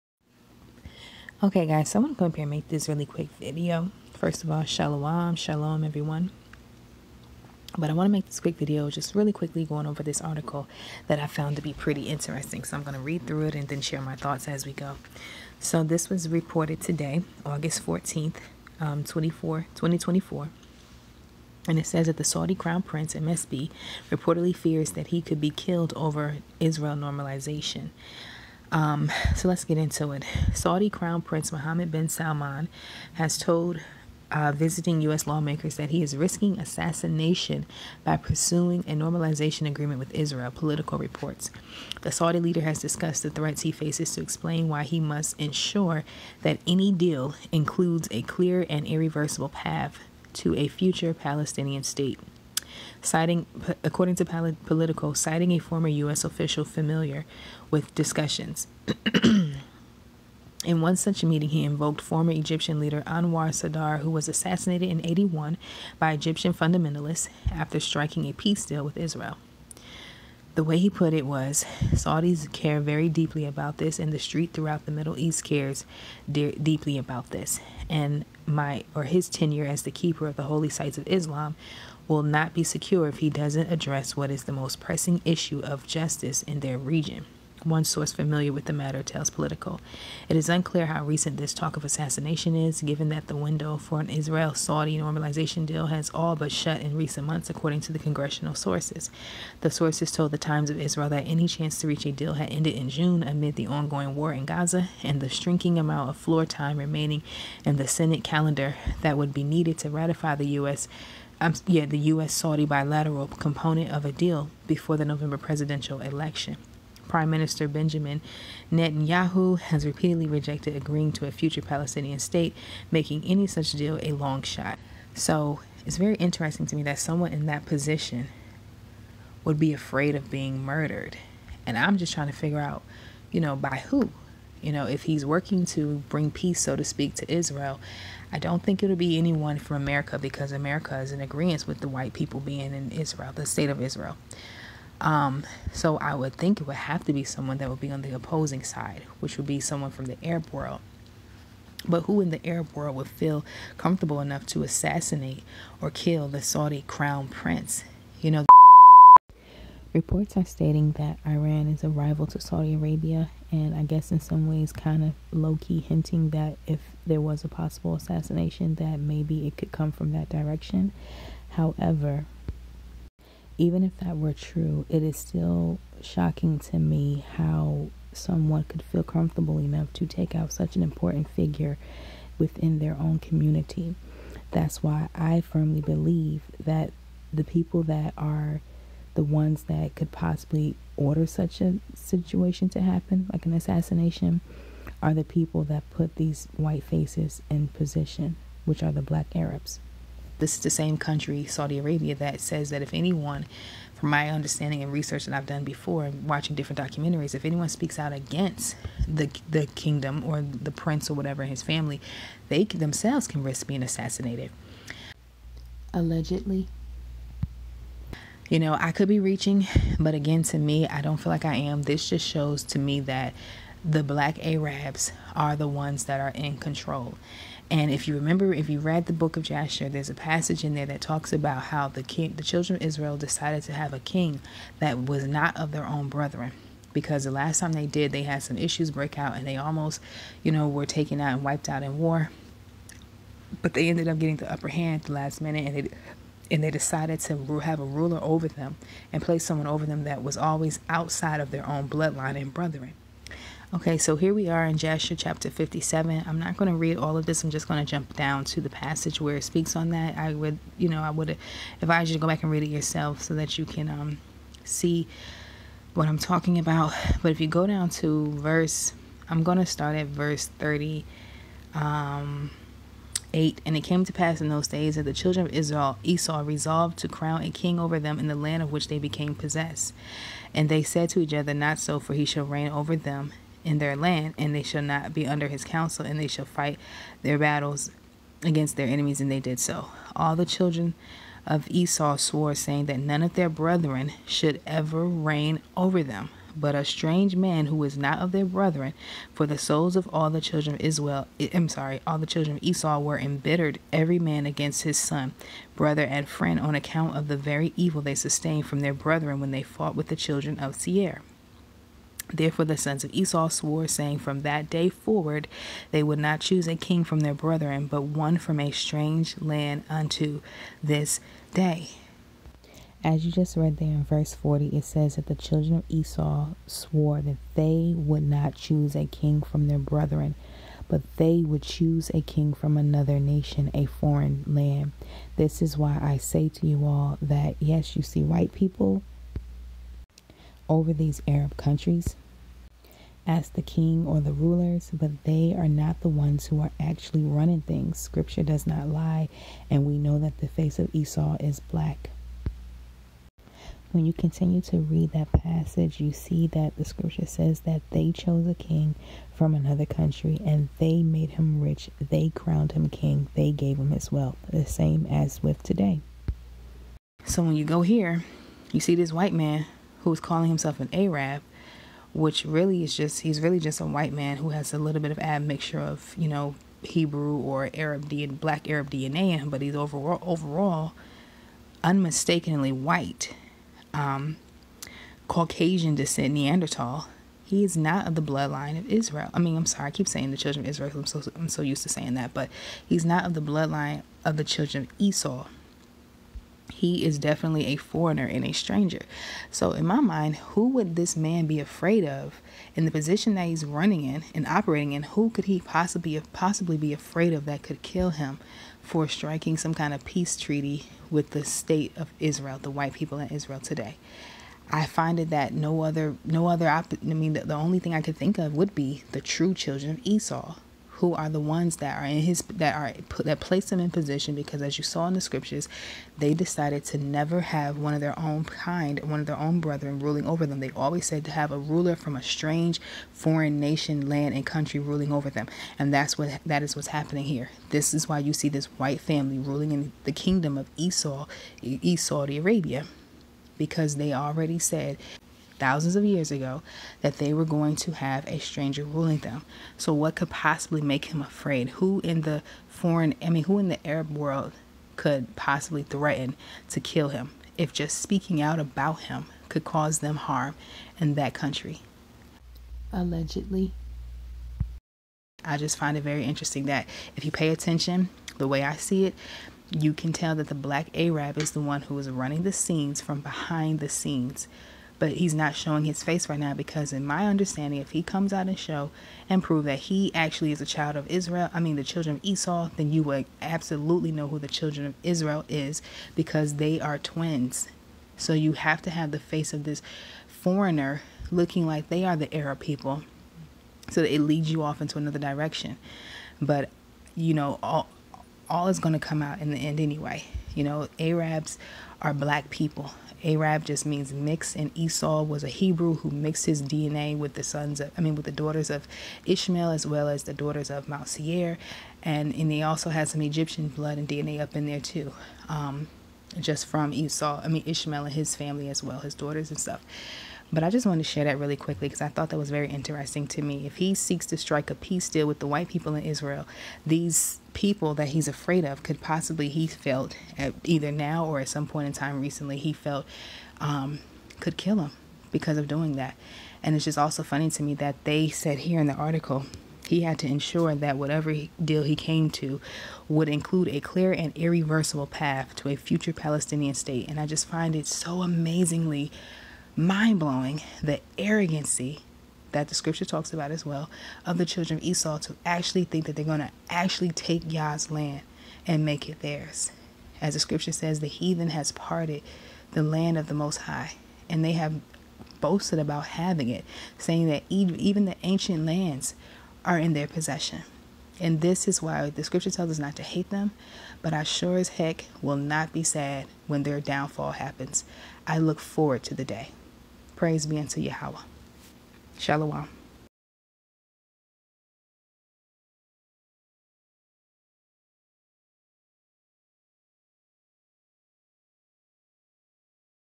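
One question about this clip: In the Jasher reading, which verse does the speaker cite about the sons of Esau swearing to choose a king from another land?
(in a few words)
40.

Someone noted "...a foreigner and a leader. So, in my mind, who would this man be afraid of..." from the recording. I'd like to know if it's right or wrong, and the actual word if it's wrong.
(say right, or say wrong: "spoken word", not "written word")
wrong: "stranger", not "leader".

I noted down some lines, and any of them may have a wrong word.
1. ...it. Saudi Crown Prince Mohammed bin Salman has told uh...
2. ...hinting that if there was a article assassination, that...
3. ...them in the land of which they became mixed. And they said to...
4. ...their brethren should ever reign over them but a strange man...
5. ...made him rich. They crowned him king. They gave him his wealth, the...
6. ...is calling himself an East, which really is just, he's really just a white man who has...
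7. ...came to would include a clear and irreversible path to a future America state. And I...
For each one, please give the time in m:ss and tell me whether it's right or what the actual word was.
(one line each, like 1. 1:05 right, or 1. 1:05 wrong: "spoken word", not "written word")
1. 0:30 right
2. 2:45 wrong: "possible", not "article"
3. 4:37 wrong: "possessed", not "mixed"
4. 4:53 right
5. 6:01 right
6. 6:10 wrong: "Arab", not "East"
7. 9:01 wrong: "Palestinian", not "America".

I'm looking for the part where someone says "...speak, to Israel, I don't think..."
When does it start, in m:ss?
2:16.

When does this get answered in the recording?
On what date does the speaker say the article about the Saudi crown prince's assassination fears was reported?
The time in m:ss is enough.
0:17.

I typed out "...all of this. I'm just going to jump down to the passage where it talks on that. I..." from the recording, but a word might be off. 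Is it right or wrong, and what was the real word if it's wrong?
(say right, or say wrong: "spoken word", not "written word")
wrong: "speaks", not "talks".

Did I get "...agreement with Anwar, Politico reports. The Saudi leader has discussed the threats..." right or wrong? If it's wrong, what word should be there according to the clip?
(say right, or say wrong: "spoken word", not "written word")
wrong: "Israel", not "Anwar".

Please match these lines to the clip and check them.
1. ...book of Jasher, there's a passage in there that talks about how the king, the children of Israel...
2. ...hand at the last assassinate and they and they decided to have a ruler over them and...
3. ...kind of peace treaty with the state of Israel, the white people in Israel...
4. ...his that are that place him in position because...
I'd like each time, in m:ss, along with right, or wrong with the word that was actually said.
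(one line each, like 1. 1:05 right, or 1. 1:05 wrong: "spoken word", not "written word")
1. 3:49 right
2. 4:04 wrong: "minute", not "assassinate"
3. 6:49 right
4. 7:02 right.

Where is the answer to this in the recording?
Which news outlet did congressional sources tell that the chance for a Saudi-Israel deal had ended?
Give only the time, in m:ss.
1:40.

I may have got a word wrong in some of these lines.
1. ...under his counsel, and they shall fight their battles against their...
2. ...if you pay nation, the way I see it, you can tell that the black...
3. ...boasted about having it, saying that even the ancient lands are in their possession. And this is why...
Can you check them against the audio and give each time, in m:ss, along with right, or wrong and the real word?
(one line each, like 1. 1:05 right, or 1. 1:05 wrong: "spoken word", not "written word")
1. 4:45 right
2. 7:47 wrong: "attention", not "nation"
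3. 9:25 right.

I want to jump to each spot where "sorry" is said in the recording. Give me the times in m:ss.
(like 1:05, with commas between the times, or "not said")
5:01, 6:29.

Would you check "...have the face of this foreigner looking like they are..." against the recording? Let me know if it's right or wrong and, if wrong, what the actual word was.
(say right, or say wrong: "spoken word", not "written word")
right.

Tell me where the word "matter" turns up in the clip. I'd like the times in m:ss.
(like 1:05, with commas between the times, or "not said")
1:28.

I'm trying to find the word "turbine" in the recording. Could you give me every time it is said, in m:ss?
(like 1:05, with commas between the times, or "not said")
not said.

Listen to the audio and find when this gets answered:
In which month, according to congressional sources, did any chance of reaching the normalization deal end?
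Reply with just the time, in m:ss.
1:42.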